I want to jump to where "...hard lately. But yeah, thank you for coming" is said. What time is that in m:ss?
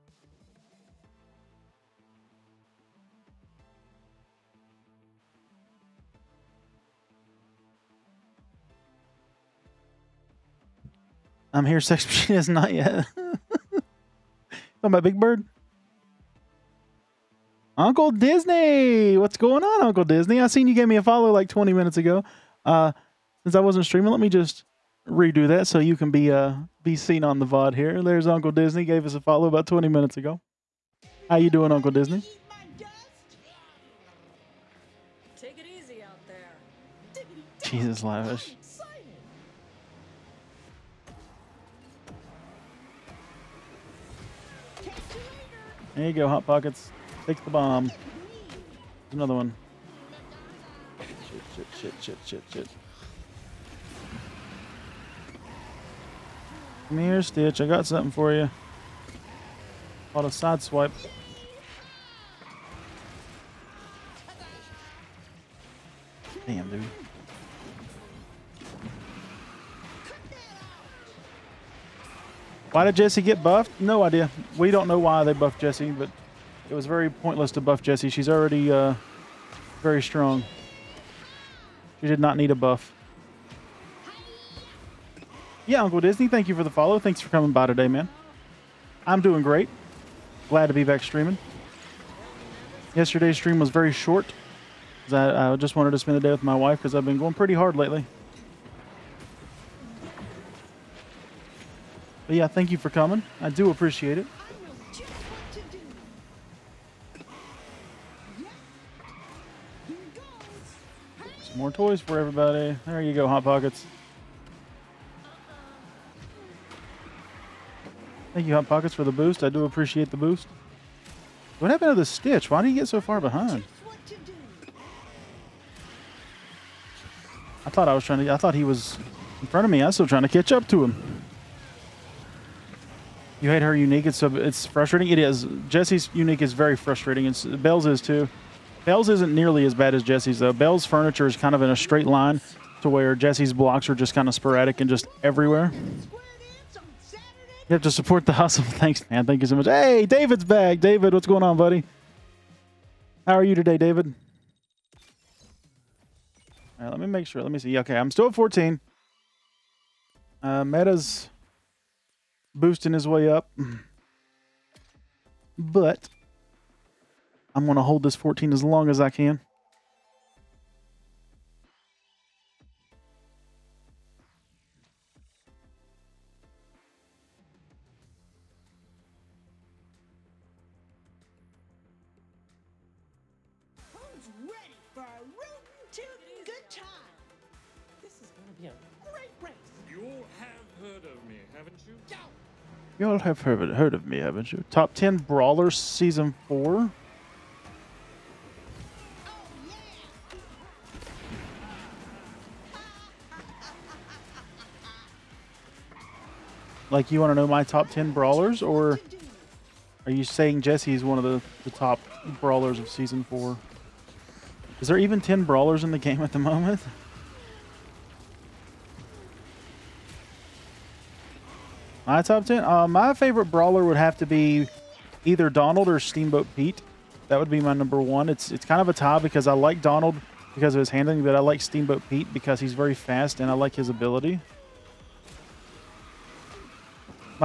1:37.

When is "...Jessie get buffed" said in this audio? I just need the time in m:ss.
1:12.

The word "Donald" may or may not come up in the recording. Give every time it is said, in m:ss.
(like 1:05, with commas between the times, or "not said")
3:45, 3:49.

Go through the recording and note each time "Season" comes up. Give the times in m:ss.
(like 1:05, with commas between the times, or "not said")
3:15, 3:32.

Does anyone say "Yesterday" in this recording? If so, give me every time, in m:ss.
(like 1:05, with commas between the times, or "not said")
1:32.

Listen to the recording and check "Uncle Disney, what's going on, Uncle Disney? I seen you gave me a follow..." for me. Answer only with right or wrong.
right.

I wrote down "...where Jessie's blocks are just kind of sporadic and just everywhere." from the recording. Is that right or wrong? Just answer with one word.
right.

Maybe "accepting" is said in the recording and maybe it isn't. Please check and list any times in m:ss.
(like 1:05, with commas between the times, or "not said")
not said.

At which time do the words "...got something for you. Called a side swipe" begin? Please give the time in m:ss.
0:57.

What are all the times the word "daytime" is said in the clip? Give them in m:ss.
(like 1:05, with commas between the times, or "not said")
not said.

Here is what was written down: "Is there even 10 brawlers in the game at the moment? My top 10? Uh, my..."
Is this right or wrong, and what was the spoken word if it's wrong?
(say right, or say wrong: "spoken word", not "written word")
right.